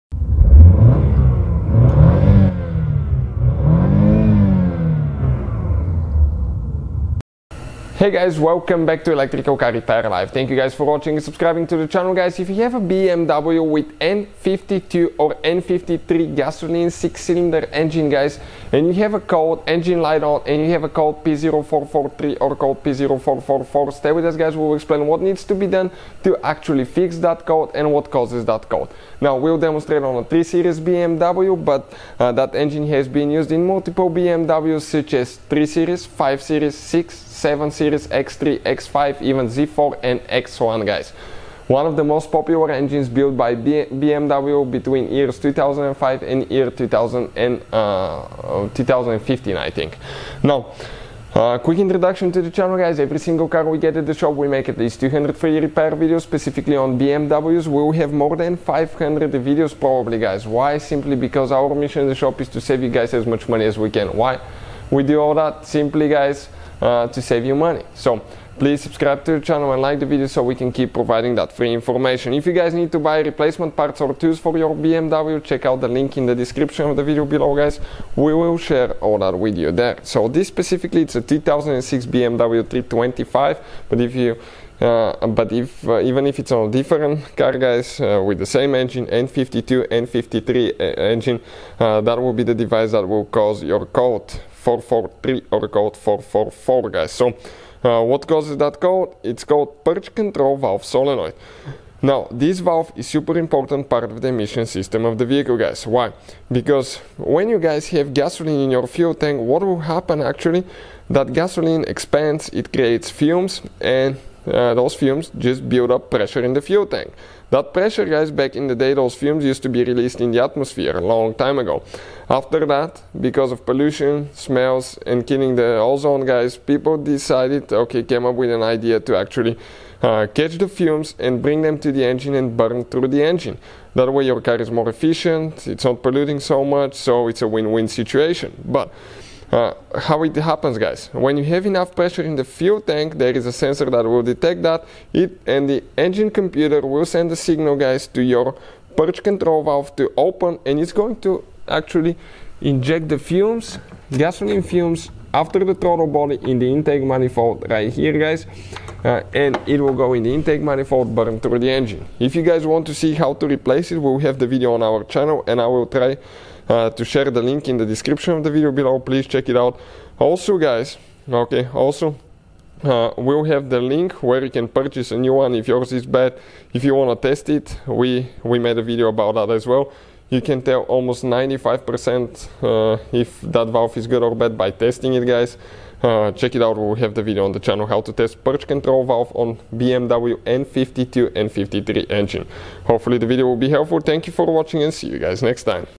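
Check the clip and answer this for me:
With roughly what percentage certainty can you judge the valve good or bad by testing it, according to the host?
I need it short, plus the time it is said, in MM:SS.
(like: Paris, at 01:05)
95%, at 03:01.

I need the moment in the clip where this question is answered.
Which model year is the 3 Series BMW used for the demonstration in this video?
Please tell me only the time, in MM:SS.
01:21.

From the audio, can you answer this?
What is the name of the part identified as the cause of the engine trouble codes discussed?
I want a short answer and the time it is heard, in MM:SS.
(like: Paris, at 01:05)
Purge control valve solenoid, at 01:39.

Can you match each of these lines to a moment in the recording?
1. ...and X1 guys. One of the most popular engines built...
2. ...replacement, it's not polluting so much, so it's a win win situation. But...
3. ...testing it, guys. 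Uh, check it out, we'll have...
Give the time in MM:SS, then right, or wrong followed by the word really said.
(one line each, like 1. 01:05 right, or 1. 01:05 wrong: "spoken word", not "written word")
1. 00:40 right
2. 02:14 wrong: "efficient", not "replacement"
3. 03:04 right.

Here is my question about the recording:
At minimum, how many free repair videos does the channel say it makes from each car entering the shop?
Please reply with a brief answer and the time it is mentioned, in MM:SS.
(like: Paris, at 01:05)
200, at 00:54.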